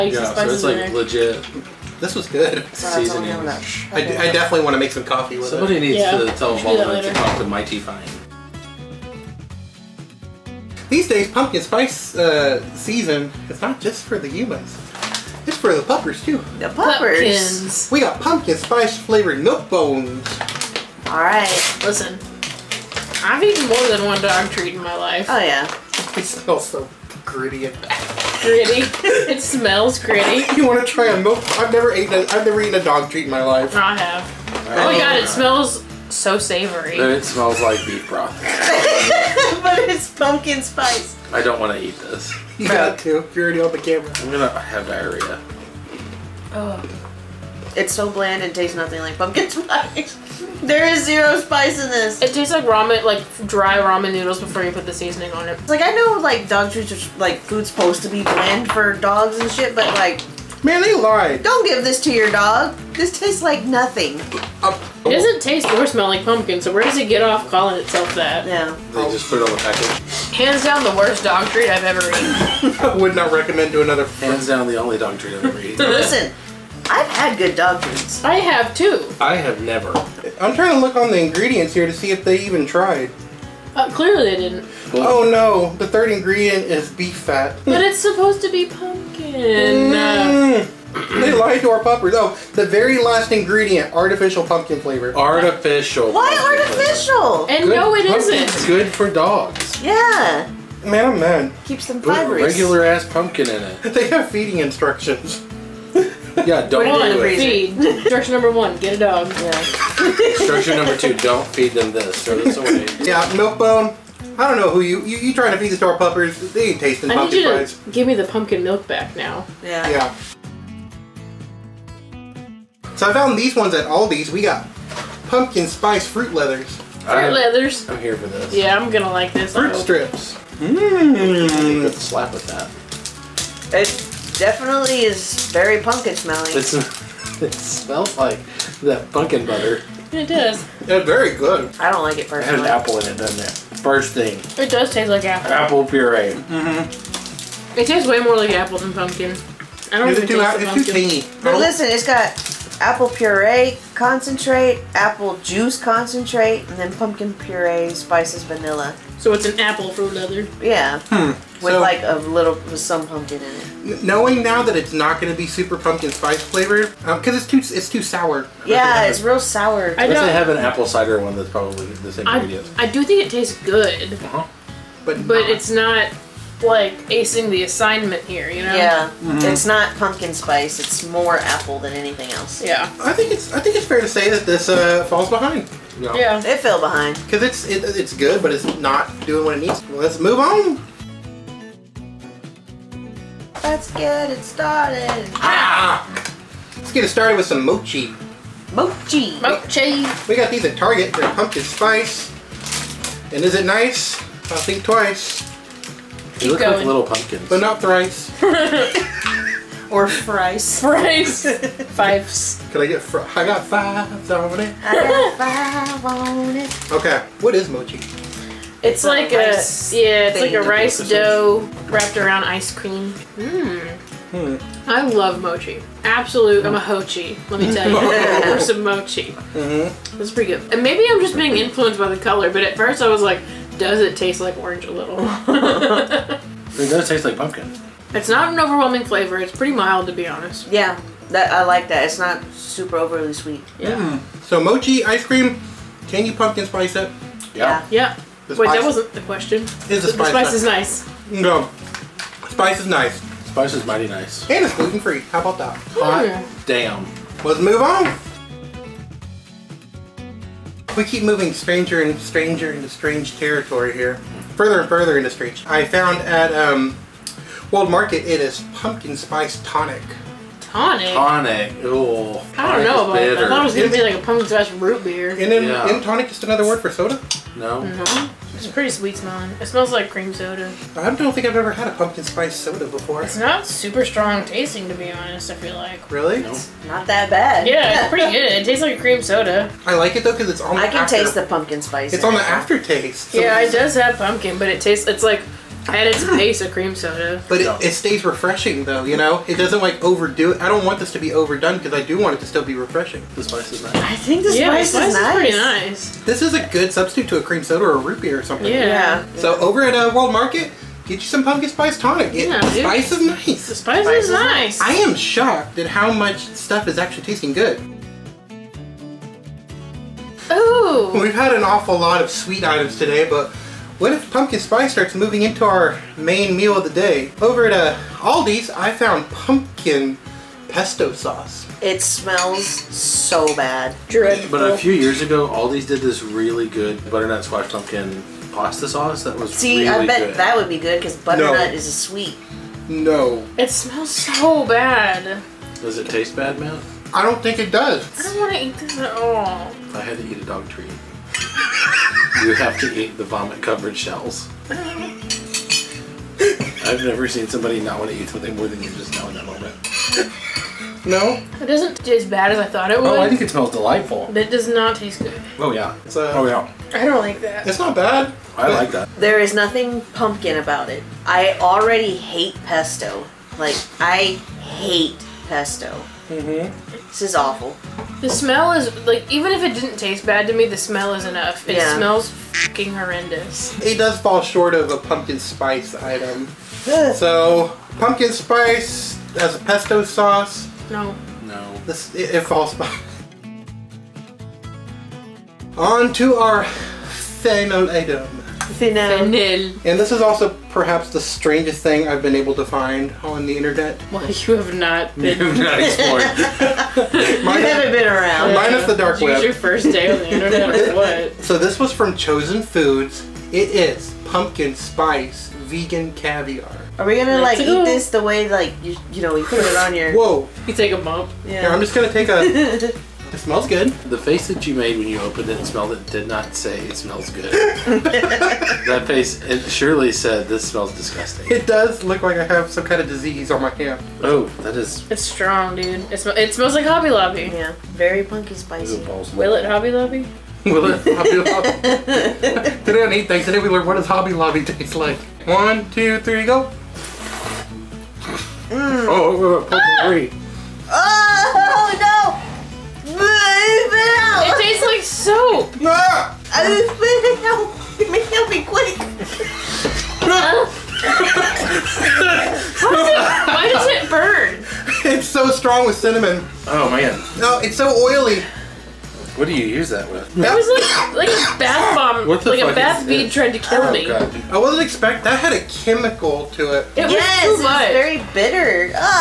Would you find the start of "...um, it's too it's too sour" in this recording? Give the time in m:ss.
2:47.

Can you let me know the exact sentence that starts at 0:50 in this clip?
There is zero spice in this.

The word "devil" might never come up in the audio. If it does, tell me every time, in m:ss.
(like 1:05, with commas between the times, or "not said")
not said.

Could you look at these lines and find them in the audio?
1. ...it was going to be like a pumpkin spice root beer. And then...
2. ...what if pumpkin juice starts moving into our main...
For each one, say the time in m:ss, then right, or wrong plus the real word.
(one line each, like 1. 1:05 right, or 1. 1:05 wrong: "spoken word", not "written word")
1. 4:33 right
2. 5:23 wrong: "spice", not "juice".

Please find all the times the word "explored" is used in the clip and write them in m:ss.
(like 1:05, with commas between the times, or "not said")
6:45.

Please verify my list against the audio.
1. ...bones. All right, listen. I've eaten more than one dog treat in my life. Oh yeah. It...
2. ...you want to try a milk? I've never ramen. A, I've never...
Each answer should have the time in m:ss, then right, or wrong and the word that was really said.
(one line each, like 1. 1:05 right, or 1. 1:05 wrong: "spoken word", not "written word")
1. 0:19 right
2. 0:30 wrong: "eaten", not "ramen".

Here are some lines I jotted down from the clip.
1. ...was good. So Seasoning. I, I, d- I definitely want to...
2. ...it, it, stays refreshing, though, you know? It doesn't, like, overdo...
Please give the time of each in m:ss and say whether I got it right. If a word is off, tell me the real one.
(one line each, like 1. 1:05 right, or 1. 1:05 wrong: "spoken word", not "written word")
1. 0:02 right
2. 4:57 right.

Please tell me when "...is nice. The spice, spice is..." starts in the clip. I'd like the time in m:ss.
5:13.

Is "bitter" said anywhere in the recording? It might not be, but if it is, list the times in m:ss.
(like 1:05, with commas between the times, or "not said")
4:33, 7:58.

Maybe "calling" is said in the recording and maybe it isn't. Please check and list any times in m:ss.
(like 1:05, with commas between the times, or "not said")
1:07.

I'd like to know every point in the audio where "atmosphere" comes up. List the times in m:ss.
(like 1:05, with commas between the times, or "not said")
not said.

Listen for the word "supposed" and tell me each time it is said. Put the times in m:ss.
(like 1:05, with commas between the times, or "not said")
0:57, 1:27.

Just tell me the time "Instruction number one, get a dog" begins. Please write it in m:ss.
1:47.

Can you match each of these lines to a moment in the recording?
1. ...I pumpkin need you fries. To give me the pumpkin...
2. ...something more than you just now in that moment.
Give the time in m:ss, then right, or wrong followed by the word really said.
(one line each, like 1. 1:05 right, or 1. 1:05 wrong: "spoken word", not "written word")
1. 1:57 right
2. 5:58 right.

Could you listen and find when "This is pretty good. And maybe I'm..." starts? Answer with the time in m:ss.
3:50.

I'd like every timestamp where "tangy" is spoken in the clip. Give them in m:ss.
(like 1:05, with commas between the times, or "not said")
2:30.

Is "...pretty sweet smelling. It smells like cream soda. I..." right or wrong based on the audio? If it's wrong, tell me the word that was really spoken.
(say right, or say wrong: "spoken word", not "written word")
right.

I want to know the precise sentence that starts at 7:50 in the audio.
That was like, like a bath bomb, like a bath bead trying to kill oh, me.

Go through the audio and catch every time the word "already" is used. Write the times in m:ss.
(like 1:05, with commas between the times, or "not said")
0:43, 6:11.